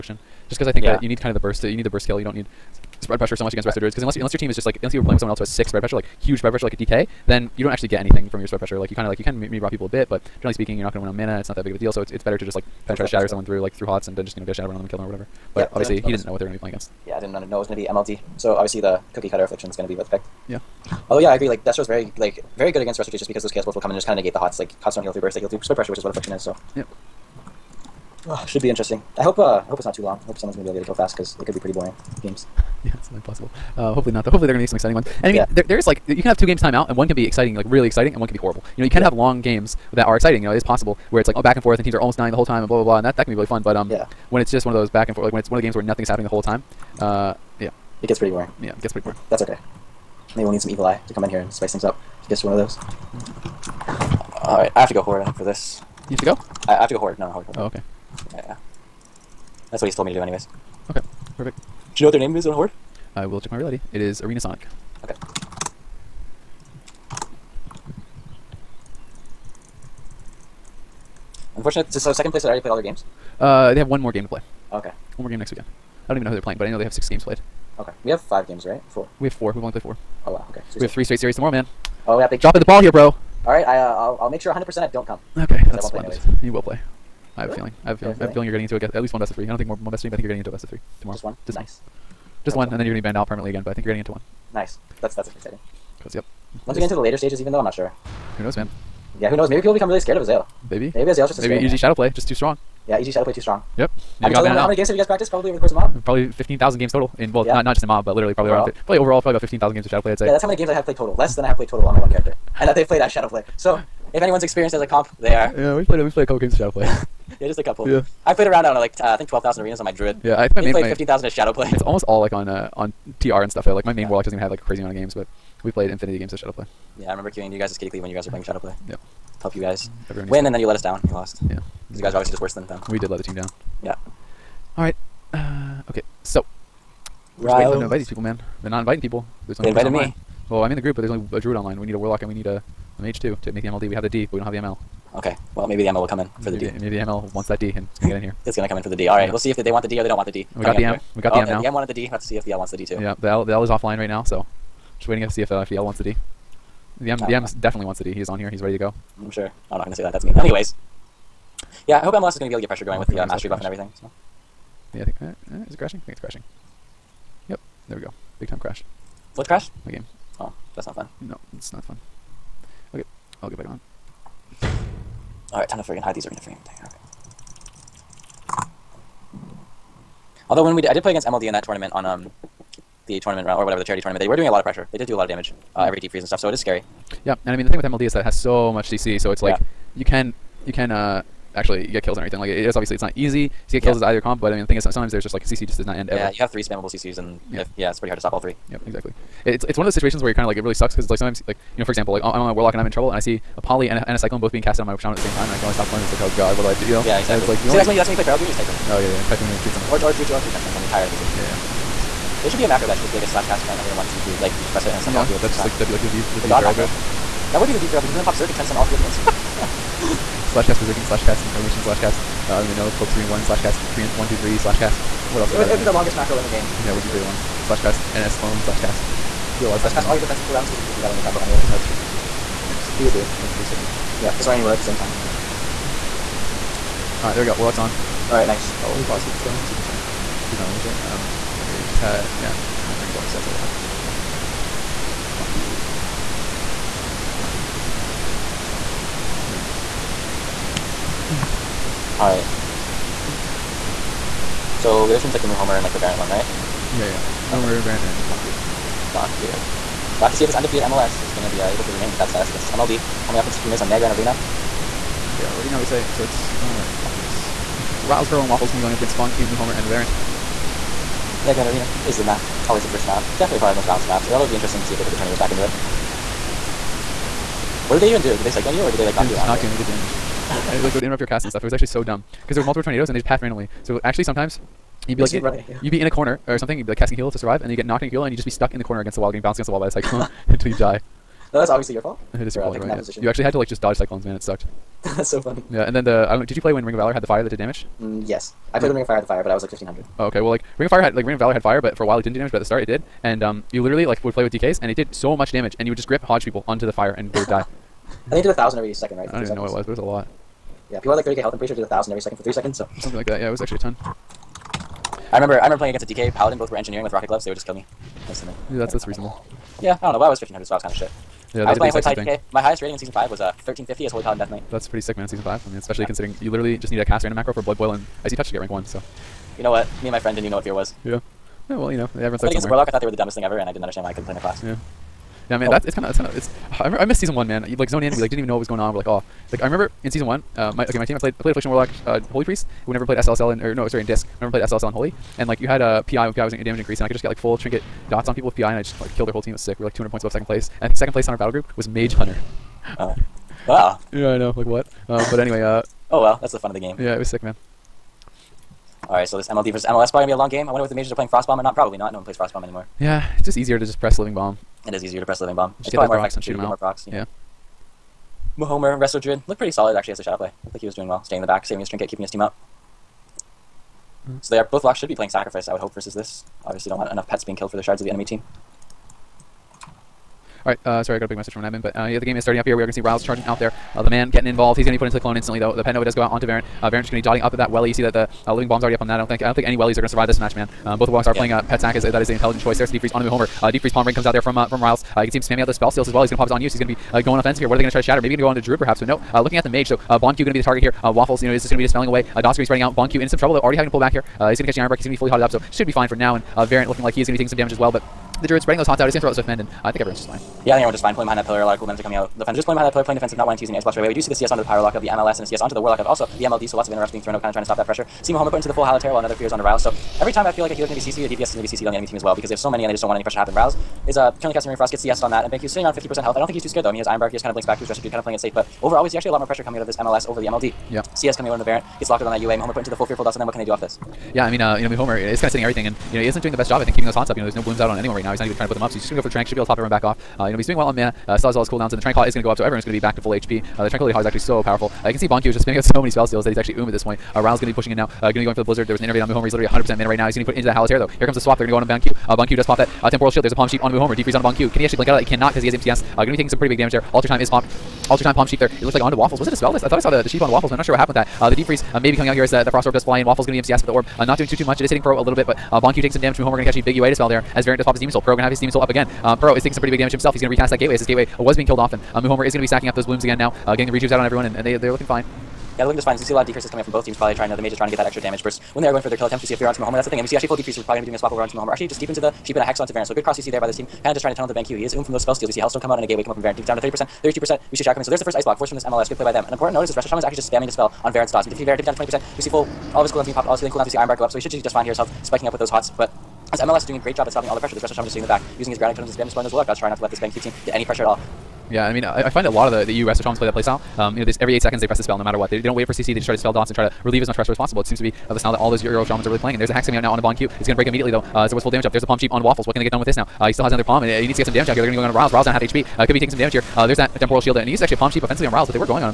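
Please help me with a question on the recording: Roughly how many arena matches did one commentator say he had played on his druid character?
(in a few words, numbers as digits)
12000.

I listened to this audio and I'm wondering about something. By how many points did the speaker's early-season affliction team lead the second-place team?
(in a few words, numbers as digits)
200.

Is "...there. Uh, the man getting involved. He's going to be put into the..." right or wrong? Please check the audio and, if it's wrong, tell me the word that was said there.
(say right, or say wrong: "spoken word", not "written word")
right.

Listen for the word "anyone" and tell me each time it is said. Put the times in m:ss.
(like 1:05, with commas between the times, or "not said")
1:54, 7:17.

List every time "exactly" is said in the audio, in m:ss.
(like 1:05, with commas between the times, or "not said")
3:18, 3:27.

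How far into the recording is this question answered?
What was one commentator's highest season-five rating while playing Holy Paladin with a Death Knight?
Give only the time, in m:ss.
5:23.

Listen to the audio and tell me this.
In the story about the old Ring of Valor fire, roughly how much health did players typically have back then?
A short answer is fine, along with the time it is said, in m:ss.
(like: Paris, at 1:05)
30k, at 5:11.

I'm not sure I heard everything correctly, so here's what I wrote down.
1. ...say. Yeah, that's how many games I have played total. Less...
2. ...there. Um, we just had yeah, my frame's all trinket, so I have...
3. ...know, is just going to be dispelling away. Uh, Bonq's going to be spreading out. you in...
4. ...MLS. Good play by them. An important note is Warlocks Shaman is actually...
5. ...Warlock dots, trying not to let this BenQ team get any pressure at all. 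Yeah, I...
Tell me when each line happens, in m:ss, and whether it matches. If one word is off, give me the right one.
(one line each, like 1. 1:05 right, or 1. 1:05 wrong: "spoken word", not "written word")
1. 1:50 right
2. 4:00 wrong: "reset", not "trinket"
3. 6:41 wrong: "Dot", not "Bonq"
4. 8:08 wrong: "Resto", not "Warlocks"
5. 8:19 right.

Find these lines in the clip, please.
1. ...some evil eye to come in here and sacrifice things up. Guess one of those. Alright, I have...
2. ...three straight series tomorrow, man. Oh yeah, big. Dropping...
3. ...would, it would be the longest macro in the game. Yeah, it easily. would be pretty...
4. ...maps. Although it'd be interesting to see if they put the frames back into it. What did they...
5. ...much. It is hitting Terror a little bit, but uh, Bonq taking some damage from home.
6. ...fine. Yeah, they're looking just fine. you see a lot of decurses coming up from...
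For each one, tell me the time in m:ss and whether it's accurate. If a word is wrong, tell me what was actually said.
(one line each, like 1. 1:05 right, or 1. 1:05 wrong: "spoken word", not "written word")
1. 0:50 wrong: "spice", not "sacrifice"
2. 1:20 right
3. 3:45 right
4. 4:34 wrong: "tornadoes", not "frames"
5. 7:44 wrong: "Pro", not "Terror"
6. 7:55 right.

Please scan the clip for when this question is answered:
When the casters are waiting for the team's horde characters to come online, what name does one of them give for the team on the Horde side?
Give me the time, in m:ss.
1:04.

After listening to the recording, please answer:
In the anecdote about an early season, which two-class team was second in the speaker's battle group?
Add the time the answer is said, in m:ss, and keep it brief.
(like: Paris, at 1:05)
Mage Hunter, at 5:51.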